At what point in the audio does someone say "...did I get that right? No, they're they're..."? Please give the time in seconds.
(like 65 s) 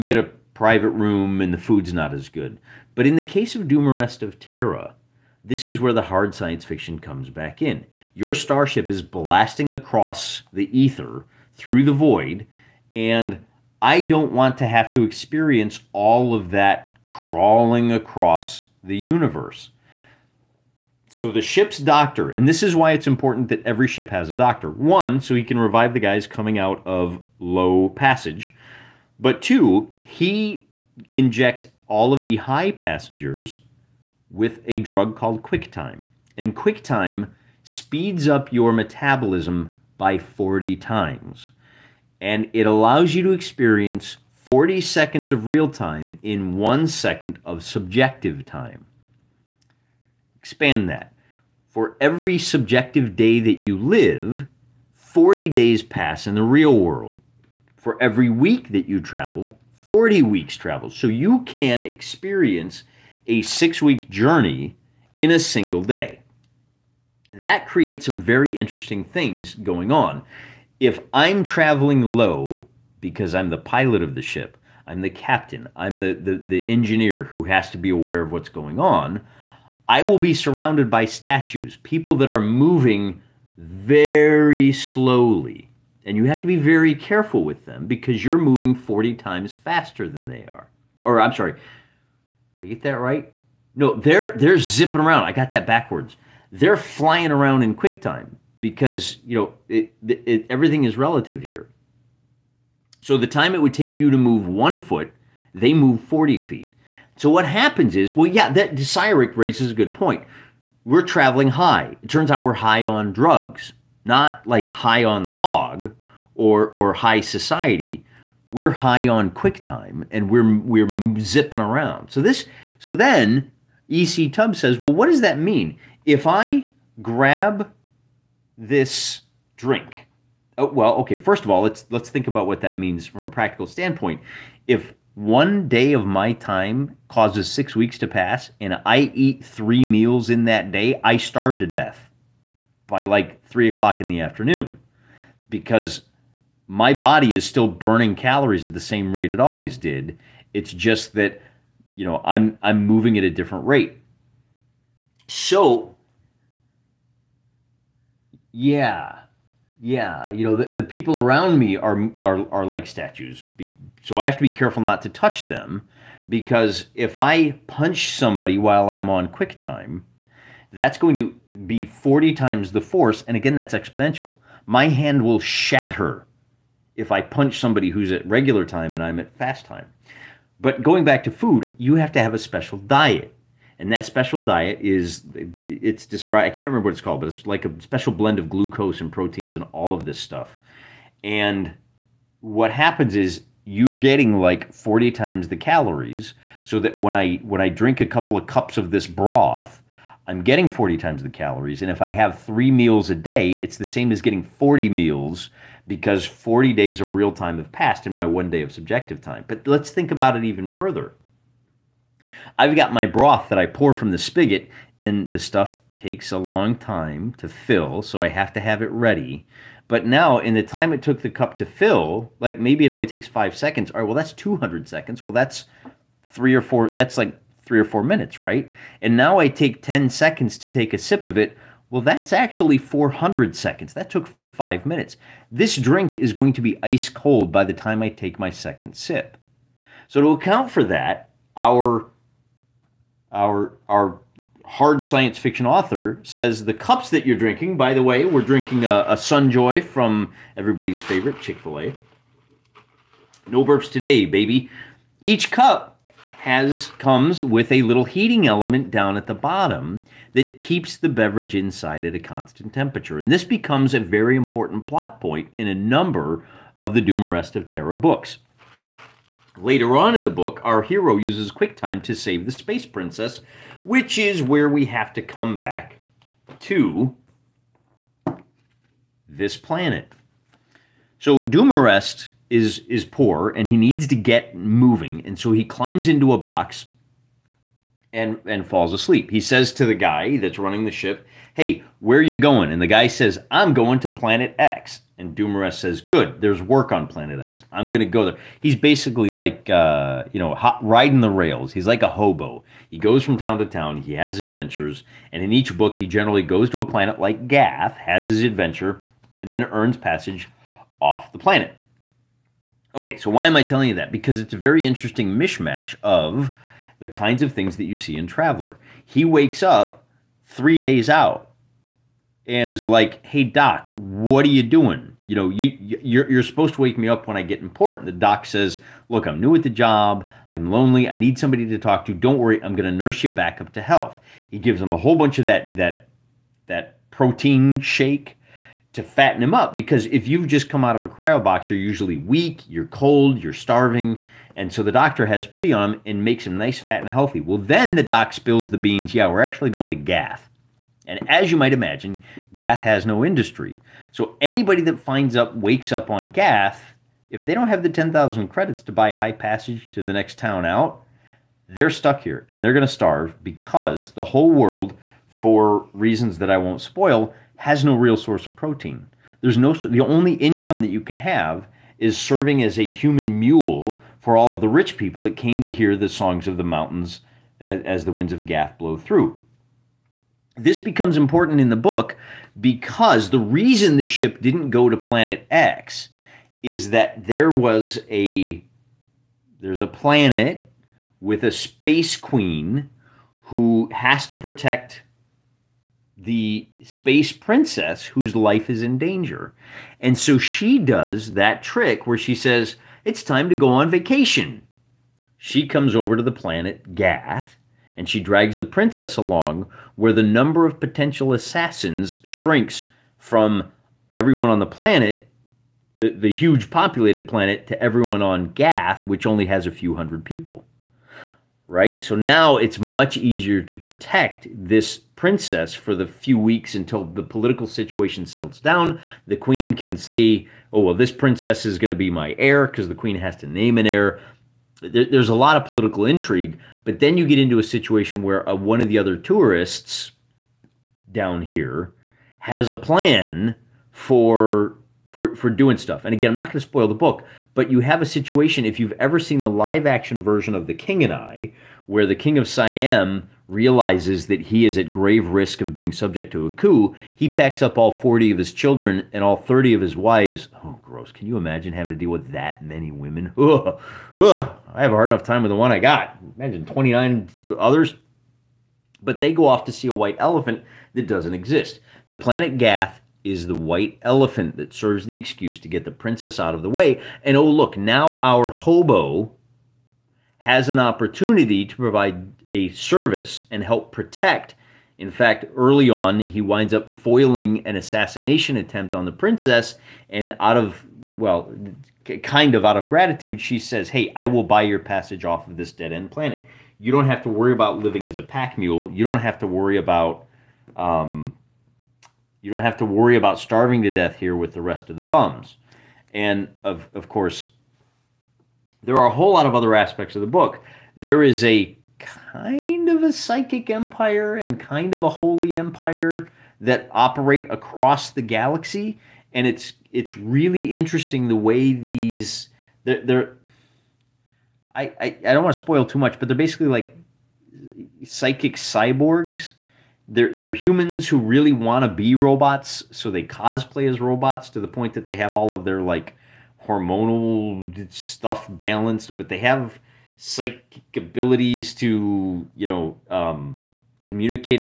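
91 s.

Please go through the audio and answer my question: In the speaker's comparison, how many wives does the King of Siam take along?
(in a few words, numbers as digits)
30.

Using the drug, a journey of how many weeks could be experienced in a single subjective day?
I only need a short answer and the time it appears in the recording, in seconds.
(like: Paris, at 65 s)
6, at 63 s.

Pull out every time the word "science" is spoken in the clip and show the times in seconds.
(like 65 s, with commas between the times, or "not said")
6 s, 245 s.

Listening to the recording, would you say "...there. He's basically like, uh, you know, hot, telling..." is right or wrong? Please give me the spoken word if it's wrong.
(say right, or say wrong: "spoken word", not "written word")
wrong: "riding", not "telling".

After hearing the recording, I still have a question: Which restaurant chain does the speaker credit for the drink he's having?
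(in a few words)
Chick Fil A.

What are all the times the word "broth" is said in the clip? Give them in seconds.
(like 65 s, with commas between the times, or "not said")
199 s, 213 s.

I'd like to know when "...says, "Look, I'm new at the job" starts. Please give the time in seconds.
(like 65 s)
328 s.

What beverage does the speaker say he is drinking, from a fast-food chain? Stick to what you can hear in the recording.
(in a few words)
Sunjoy.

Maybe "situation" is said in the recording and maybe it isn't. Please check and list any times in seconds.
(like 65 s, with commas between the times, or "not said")
427 s, 437 s, 448 s.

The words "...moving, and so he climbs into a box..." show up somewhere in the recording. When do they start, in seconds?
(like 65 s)
284 s.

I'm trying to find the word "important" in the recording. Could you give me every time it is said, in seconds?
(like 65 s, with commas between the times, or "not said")
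23 s, 264 s, 327 s, 381 s.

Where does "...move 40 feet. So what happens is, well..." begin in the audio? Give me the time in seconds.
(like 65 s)
105 s.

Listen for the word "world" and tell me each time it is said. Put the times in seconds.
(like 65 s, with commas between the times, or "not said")
56 s, 364 s.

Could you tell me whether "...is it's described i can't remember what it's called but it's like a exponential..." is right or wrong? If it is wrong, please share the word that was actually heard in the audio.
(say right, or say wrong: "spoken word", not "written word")
wrong: "special", not "exponential".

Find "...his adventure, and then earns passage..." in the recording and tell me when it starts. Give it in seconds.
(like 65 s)
308 s.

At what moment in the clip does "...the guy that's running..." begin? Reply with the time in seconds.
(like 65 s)
289 s.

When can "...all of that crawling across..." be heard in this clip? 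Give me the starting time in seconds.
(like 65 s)
15 s.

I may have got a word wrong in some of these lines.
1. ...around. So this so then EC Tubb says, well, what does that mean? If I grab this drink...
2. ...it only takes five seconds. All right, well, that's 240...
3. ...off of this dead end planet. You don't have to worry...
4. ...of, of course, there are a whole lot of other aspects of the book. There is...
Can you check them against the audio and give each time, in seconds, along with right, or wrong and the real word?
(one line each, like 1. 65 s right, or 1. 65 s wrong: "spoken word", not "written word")
1. 121 s right
2. 222 s wrong: "200", not "240"
3. 495 s right
4. 506 s right.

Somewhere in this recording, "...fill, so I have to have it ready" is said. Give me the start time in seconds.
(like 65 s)
217 s.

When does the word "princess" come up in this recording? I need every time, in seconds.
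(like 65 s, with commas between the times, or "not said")
272 s, 397 s, 408 s, 425 s, 431 s, 475 s, 489 s.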